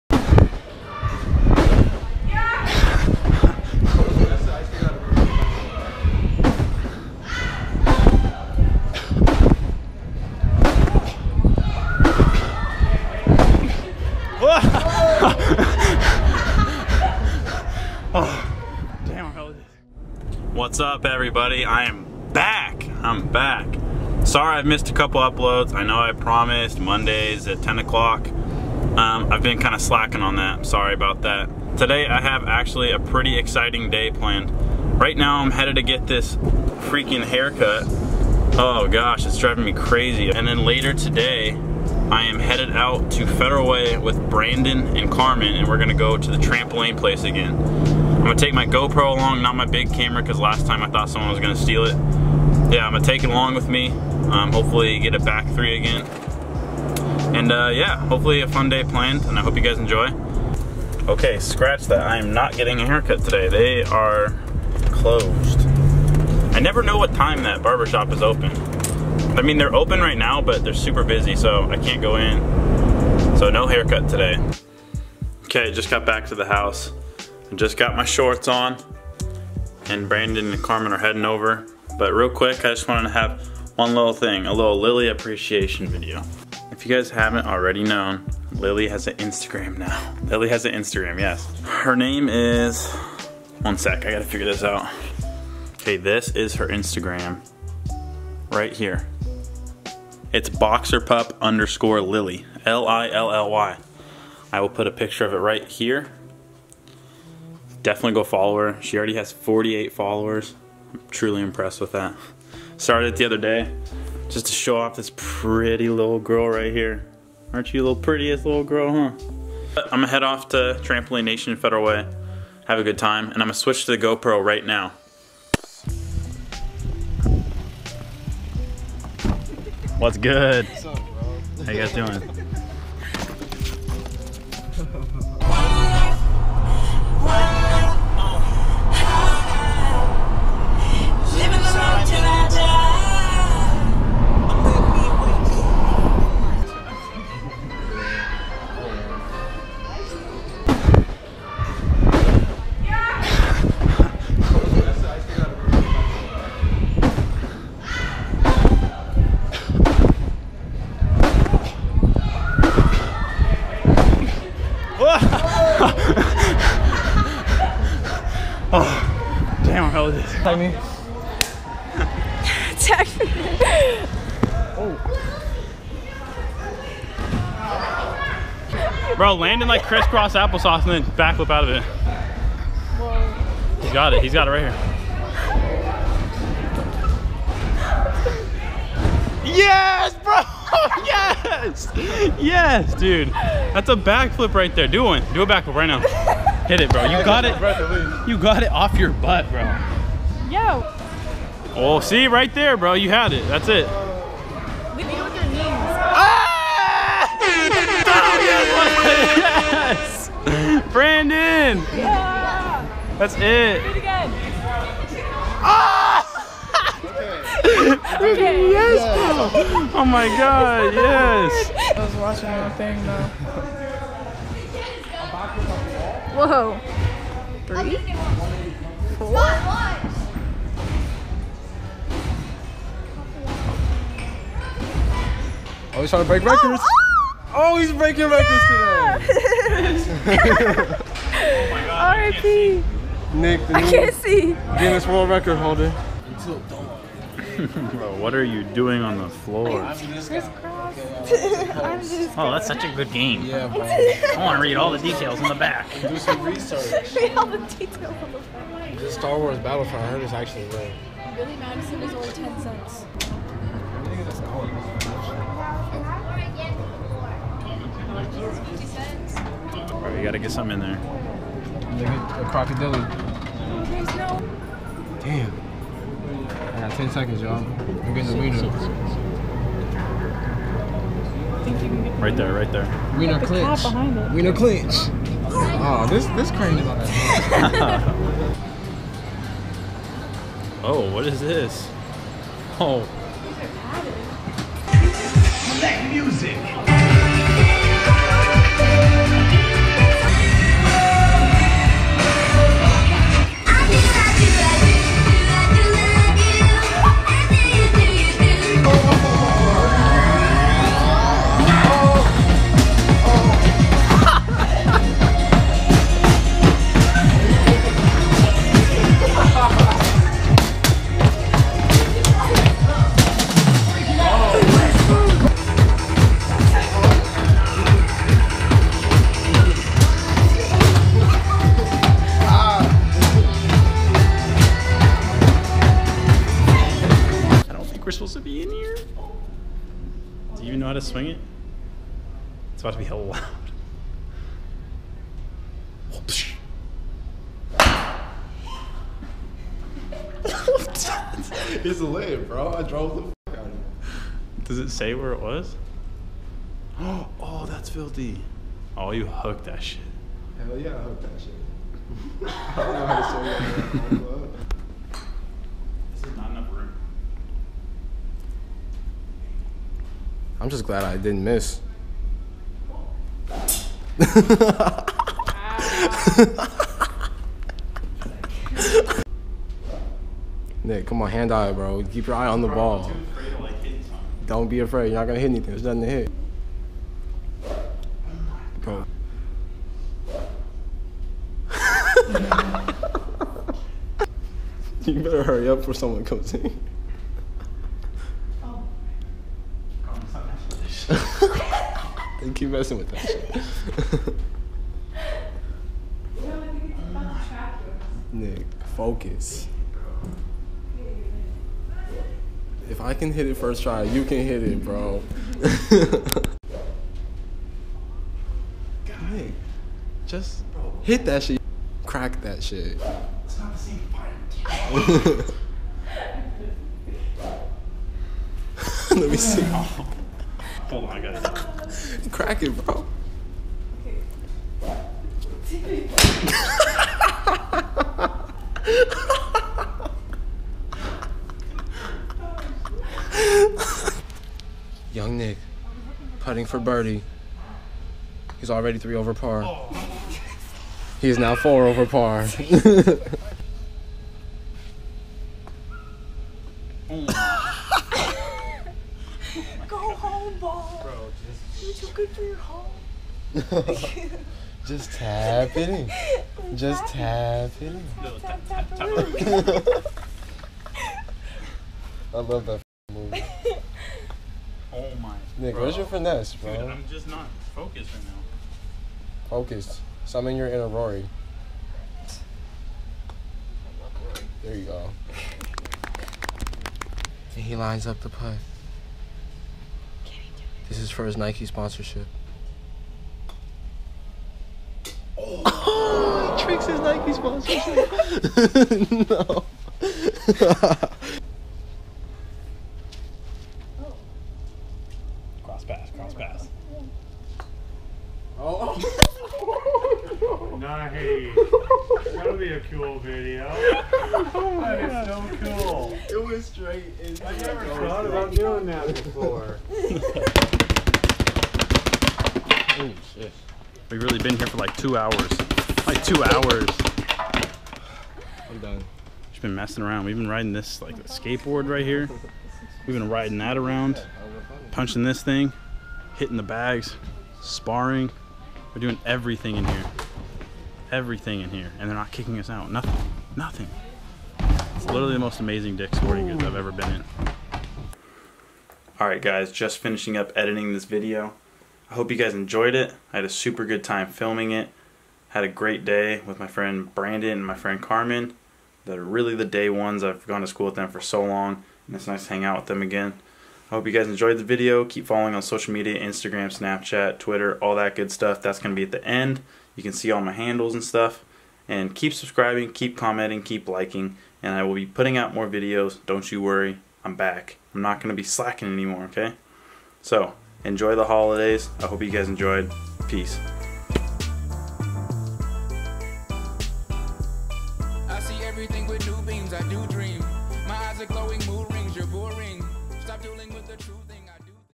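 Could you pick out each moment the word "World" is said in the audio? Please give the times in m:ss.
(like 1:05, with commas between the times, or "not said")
4:05.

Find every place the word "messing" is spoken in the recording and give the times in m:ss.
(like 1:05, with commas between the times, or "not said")
6:42, 8:49.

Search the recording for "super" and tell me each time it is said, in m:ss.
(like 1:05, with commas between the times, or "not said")
1:10, 9:13.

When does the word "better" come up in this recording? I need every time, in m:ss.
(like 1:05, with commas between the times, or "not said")
6:35.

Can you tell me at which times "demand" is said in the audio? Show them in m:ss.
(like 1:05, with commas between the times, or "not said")
not said.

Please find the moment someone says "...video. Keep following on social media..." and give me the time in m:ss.
9:24.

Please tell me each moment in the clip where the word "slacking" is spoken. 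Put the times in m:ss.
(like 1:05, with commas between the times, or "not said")
0:29, 9:38.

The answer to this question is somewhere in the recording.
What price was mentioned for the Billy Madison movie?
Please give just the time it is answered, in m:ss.
4:22.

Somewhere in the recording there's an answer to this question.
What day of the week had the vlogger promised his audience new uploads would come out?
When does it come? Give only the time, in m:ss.
0:26.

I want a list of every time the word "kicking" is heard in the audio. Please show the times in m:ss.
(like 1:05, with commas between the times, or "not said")
9:02.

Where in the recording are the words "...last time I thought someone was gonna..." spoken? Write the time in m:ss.
0:50.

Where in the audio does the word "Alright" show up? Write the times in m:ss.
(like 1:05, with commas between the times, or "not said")
9:09.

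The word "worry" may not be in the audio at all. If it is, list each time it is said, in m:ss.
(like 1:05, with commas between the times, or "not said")
9:36.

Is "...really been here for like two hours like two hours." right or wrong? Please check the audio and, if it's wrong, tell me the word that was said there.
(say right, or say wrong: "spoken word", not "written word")
right.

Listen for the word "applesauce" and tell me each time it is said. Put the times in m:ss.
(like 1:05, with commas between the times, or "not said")
3:00.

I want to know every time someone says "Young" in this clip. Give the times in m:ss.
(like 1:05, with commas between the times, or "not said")
7:25.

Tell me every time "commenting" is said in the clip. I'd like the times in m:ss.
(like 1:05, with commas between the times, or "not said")
9:33.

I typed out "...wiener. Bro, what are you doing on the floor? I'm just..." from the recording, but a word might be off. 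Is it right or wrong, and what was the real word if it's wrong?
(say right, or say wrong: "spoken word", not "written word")
wrong: "holder", not "wiener".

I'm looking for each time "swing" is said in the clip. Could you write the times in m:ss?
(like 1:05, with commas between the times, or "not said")
5:40, 6:04.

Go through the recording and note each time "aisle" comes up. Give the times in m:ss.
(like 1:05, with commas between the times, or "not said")
not said.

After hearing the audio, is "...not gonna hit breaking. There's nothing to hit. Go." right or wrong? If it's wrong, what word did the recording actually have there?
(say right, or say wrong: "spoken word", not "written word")
wrong: "anything", not "breaking".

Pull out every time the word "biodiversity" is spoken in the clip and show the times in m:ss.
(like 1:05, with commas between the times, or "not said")
not said.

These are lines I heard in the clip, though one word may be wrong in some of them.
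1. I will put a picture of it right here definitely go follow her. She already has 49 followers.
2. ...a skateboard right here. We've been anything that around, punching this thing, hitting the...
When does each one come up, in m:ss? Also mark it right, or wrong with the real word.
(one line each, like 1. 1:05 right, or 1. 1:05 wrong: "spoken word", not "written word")
1. 1:44 wrong: "48", not "49"
2. 8:51 wrong: "riding", not "anything".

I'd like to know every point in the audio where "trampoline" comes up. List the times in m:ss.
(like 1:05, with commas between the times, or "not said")
0:46, 2:00.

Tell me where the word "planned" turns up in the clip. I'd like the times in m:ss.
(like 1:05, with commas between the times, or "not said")
0:34, 0:58.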